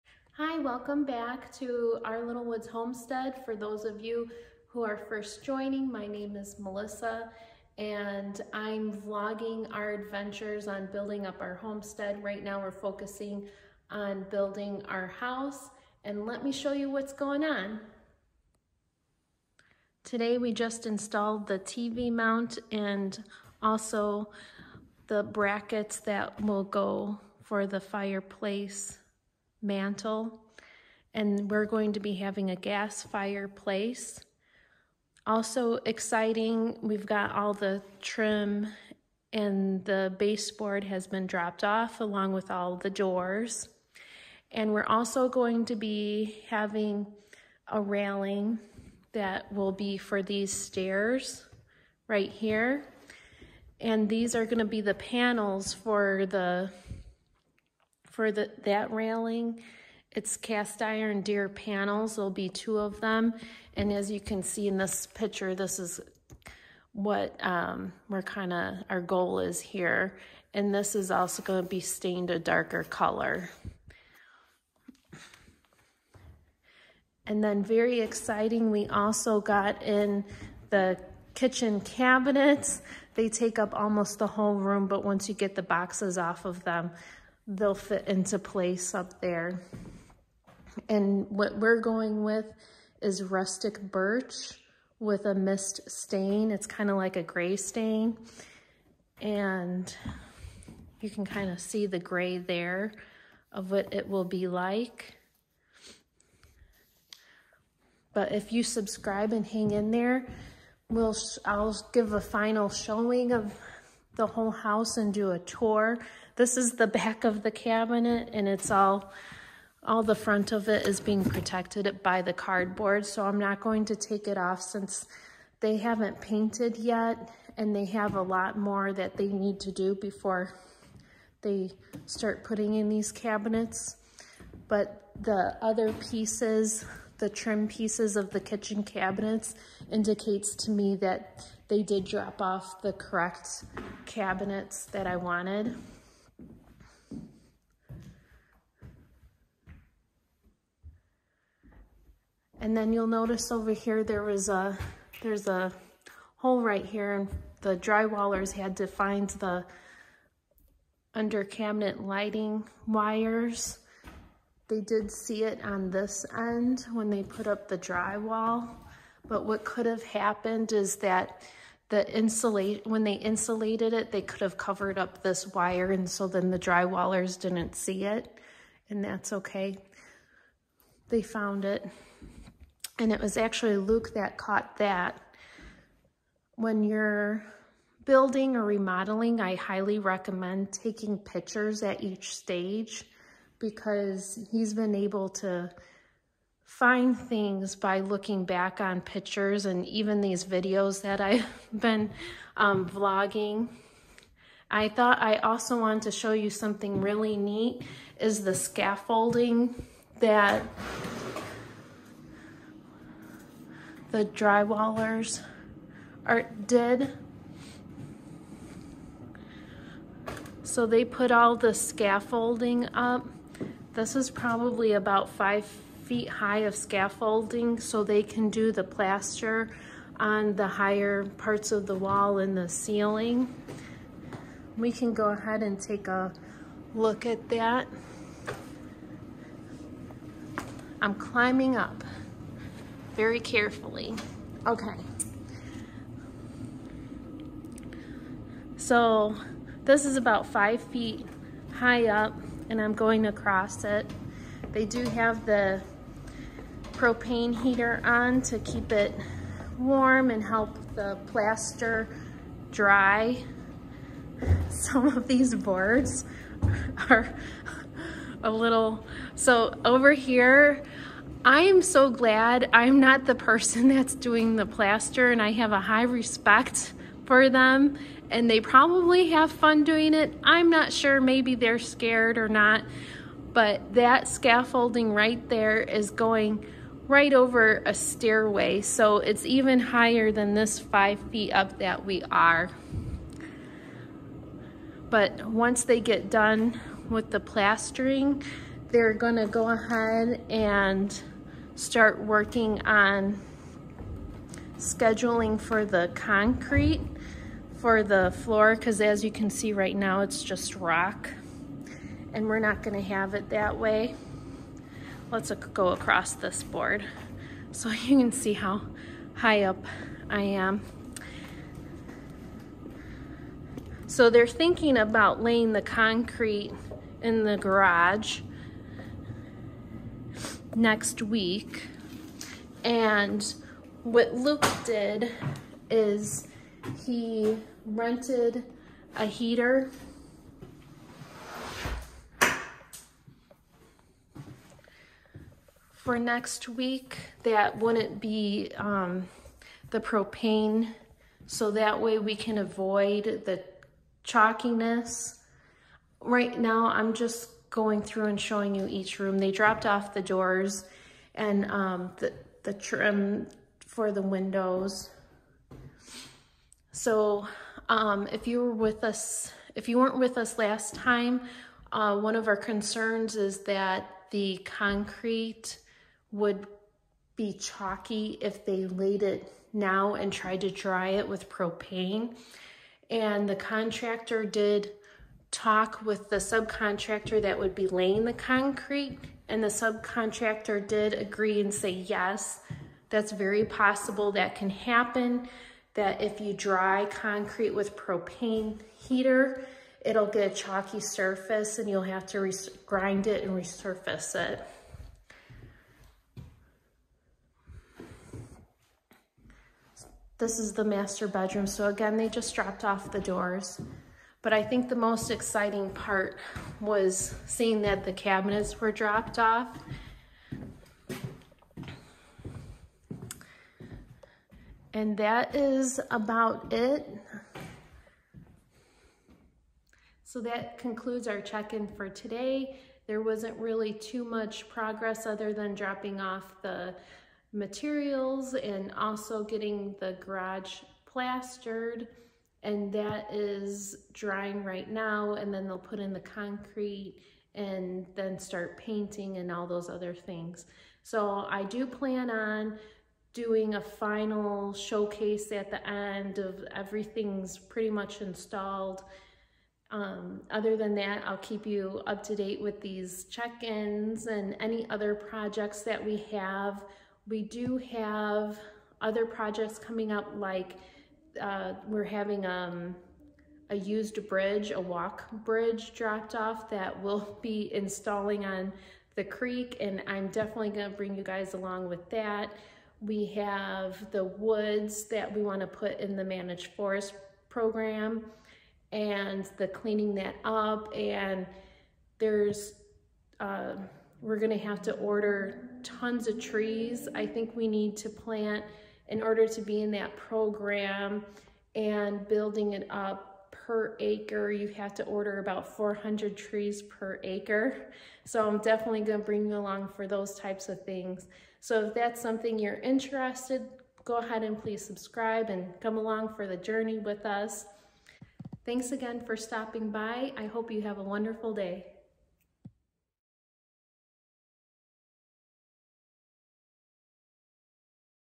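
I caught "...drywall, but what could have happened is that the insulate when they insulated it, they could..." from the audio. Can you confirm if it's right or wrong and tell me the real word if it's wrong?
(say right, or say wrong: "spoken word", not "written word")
right.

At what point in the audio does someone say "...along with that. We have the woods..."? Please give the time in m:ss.
8:01.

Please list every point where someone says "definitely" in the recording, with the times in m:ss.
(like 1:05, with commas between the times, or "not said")
8:00, 8:28.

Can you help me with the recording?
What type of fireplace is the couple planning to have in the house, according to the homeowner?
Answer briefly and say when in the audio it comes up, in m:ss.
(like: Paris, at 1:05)
Gas, at 0:32.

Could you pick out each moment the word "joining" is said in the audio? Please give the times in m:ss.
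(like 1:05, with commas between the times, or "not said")
0:05.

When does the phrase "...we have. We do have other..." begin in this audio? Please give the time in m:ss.
7:46.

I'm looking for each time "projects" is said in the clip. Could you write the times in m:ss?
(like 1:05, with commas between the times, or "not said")
7:45, 7:49.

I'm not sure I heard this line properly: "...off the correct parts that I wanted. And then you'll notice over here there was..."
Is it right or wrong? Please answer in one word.
wrong.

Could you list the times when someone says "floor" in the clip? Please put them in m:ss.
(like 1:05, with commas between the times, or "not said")
5:08.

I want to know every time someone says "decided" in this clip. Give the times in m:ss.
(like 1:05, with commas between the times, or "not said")
not said.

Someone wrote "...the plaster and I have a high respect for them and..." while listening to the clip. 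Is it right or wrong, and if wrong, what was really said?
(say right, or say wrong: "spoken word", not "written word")
right.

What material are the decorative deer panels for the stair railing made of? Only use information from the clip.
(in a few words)
Cast iron.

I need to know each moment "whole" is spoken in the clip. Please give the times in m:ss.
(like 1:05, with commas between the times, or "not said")
1:24, 1:54.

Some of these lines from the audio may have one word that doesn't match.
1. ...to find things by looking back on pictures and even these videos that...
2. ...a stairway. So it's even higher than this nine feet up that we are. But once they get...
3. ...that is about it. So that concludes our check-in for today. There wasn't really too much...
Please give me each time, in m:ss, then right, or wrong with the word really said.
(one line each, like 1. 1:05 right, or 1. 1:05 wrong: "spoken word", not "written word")
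1. 3:15 right
2. 4:47 wrong: "five", not "nine"
3. 7:05 right.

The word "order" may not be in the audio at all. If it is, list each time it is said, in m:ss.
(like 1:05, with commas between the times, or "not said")
8:14, 8:19, 8:25.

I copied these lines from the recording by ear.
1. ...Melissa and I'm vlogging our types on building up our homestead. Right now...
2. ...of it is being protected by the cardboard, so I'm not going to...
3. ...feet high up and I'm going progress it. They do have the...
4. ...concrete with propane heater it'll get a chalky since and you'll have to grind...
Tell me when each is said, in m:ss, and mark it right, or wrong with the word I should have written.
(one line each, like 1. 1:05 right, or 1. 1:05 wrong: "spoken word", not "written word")
1. 0:06 wrong: "adventures", not "types"
2. 2:00 right
3. 4:10 wrong: "across", not "progress"
4. 6:37 wrong: "surface", not "since".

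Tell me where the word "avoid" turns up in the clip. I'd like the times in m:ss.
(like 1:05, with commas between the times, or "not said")
5:52.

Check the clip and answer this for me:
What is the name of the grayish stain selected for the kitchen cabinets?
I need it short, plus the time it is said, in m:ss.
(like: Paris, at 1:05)
Mist, at 1:35.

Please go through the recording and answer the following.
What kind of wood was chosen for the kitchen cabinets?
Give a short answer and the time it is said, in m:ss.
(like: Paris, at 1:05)
Rustic birch, at 1:33.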